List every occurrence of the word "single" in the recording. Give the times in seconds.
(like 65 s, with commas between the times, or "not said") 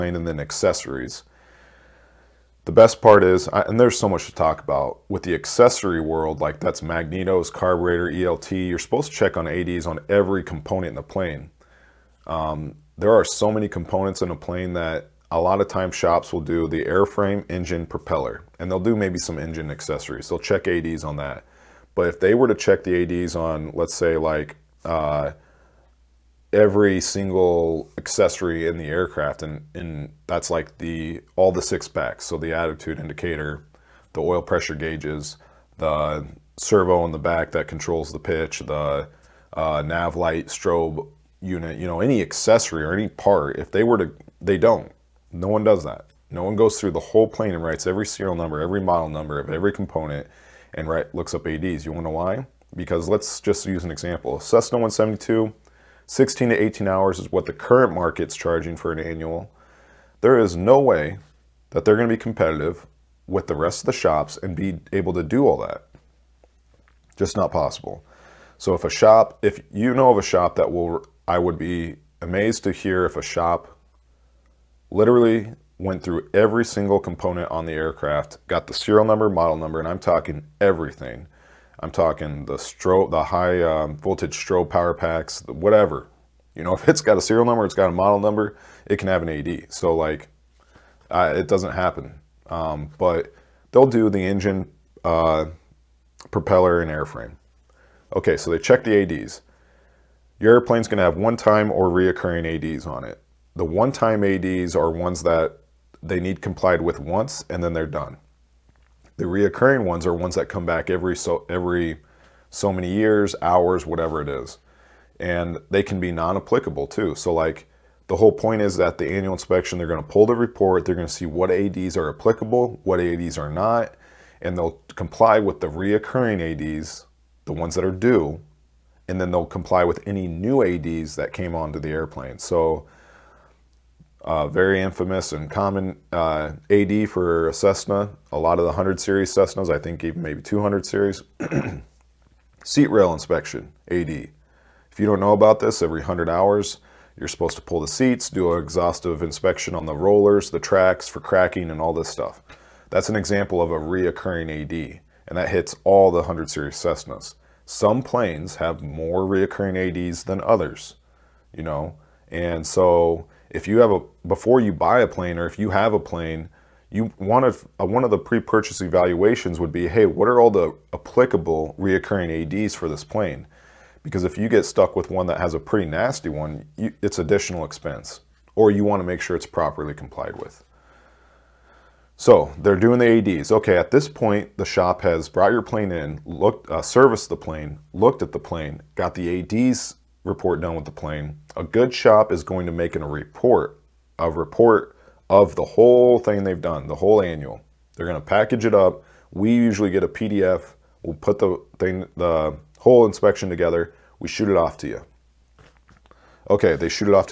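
27 s, 76 s.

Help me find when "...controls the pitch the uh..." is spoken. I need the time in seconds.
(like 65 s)
37 s.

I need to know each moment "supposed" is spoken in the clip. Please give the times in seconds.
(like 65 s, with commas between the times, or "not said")
8 s, 147 s.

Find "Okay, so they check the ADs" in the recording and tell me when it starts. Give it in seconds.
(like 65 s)
98 s.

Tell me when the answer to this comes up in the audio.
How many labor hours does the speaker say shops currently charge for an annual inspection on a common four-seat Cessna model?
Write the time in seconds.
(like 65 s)
56 s.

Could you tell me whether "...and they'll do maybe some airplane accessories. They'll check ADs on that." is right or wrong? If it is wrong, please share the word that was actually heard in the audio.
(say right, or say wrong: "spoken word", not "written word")
wrong: "engine", not "airplane".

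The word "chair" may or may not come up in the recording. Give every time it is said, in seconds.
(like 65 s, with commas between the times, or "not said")
not said.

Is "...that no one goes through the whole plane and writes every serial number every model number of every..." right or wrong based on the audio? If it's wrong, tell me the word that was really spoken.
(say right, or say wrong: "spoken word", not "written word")
right.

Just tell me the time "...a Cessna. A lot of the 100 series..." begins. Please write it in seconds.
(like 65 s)
137 s.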